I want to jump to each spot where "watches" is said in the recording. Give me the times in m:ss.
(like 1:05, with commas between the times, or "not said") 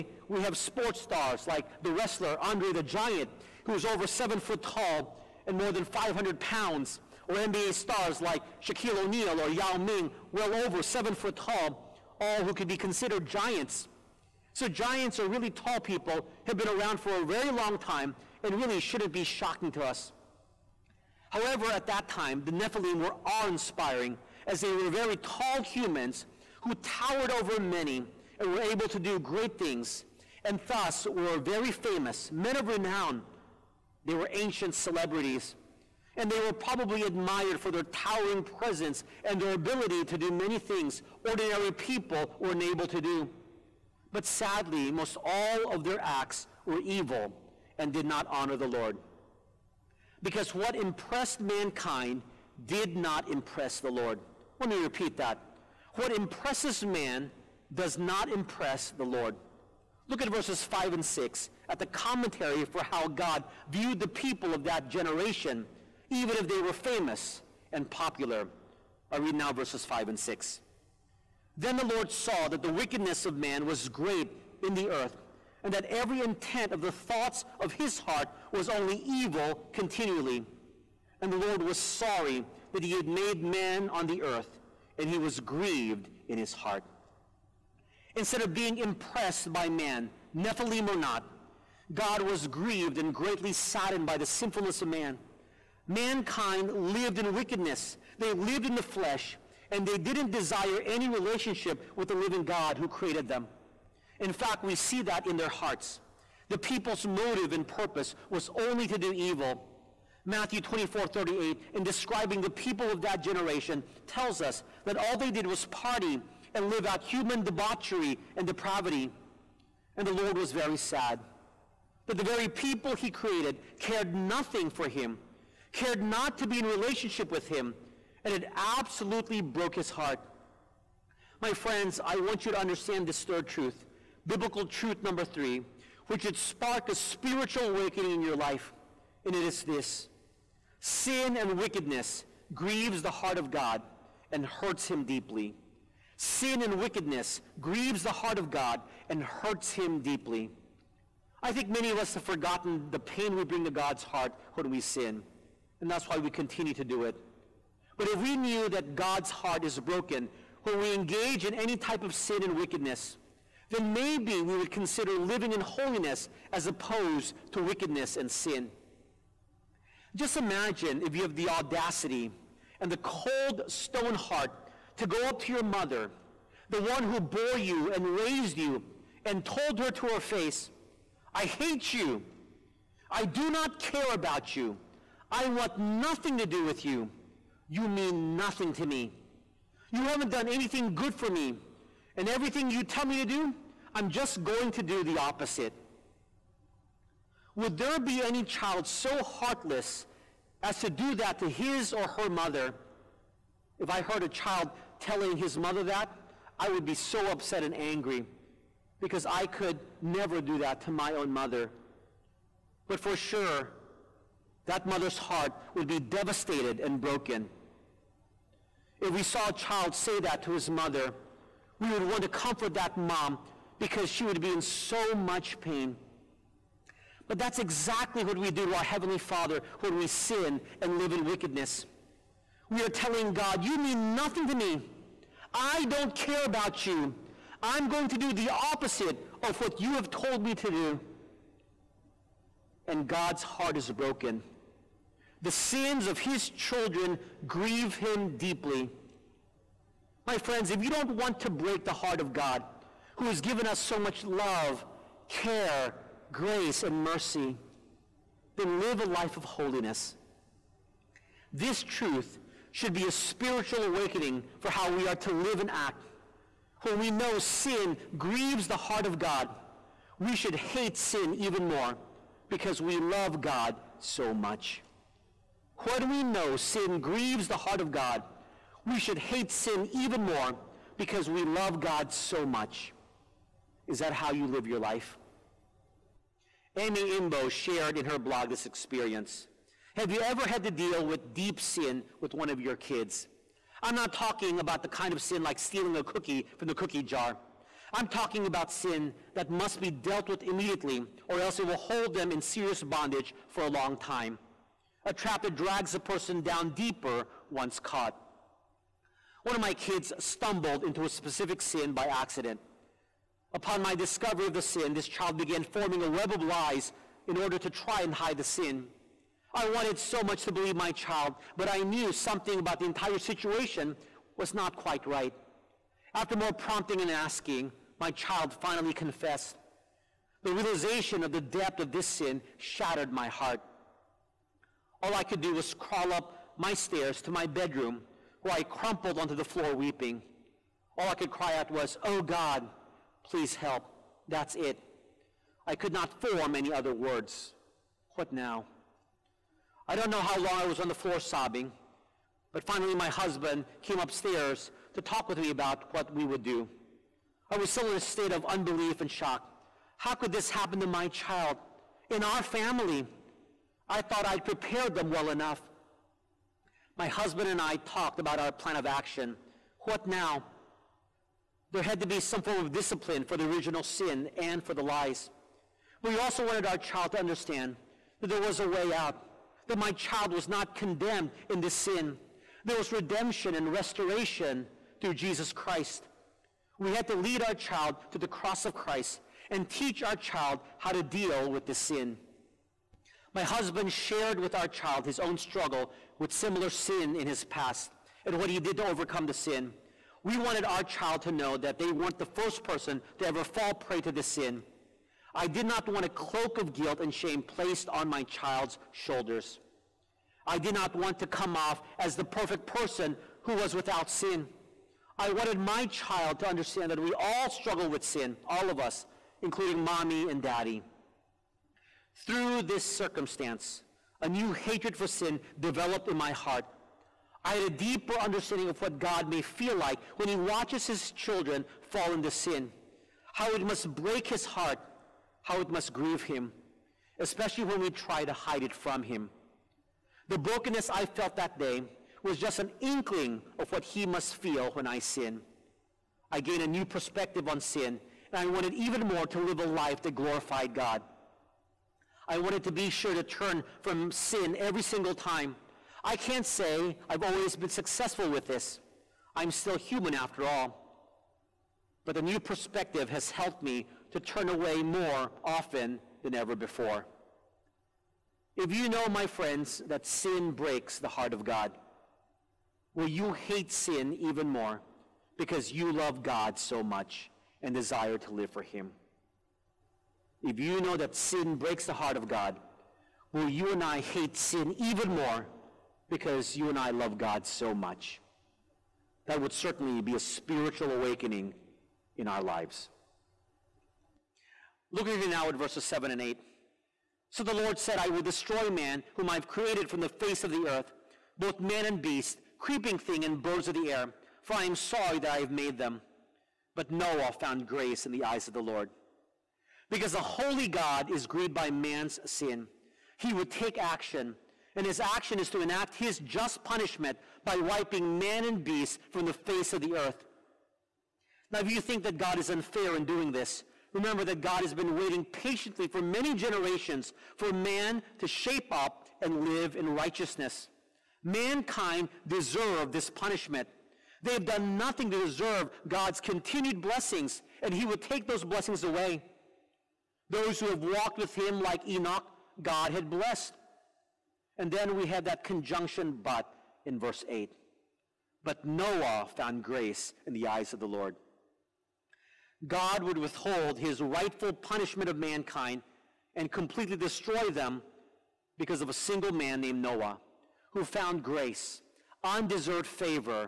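7:10.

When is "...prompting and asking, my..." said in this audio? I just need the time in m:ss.
5:26.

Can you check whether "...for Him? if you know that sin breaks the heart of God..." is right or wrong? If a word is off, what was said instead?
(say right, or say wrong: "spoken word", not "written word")
right.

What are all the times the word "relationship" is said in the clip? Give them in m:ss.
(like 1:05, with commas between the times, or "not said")
1:41, 2:06.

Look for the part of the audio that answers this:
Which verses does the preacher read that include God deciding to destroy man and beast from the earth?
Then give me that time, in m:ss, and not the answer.
8:15.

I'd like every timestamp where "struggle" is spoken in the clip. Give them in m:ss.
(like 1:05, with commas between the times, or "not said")
6:35, 6:57.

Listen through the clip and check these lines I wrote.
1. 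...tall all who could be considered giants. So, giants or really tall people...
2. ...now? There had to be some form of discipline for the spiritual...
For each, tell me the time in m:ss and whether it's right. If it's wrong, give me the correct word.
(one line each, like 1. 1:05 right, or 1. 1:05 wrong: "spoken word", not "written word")
1. 0:11 right
2. 6:10 wrong: "original", not "spiritual".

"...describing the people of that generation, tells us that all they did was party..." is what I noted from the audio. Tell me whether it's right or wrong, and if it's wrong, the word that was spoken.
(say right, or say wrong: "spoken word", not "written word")
right.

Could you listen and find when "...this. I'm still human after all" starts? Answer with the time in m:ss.
7:38.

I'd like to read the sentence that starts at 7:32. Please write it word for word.
I wanted to be sure to turn from sin every single time.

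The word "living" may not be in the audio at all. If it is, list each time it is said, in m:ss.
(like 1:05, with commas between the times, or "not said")
1:42, 2:45.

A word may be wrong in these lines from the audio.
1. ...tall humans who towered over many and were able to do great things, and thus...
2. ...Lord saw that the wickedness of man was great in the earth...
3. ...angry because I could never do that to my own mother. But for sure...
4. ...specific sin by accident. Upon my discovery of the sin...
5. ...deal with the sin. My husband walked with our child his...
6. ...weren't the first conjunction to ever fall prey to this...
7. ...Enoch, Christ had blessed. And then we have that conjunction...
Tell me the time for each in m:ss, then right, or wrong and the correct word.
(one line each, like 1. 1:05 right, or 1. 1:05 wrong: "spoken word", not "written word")
1. 0:25 right
2. 1:11 right
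3. 3:27 right
4. 5:11 right
5. 6:31 wrong: "shared", not "walked"
6. 6:41 wrong: "person", not "conjunction"
7. 9:01 wrong: "God", not "Christ".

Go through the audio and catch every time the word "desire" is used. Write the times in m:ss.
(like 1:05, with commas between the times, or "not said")
1:40, 7:57.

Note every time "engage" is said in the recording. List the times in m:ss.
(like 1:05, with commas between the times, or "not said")
2:40.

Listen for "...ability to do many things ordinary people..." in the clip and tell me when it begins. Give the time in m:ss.
0:39.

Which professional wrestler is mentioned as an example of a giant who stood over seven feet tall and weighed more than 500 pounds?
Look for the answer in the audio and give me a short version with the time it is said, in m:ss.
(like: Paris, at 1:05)
Andre the Giant, at 0:02.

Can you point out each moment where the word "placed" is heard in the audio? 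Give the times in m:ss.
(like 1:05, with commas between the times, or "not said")
6:47.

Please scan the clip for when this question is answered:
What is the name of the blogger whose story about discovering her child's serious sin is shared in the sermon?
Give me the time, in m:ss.
4:46.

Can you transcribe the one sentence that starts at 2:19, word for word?
And it is this sin and wickedness grieves the heart of God and hurts him deeply.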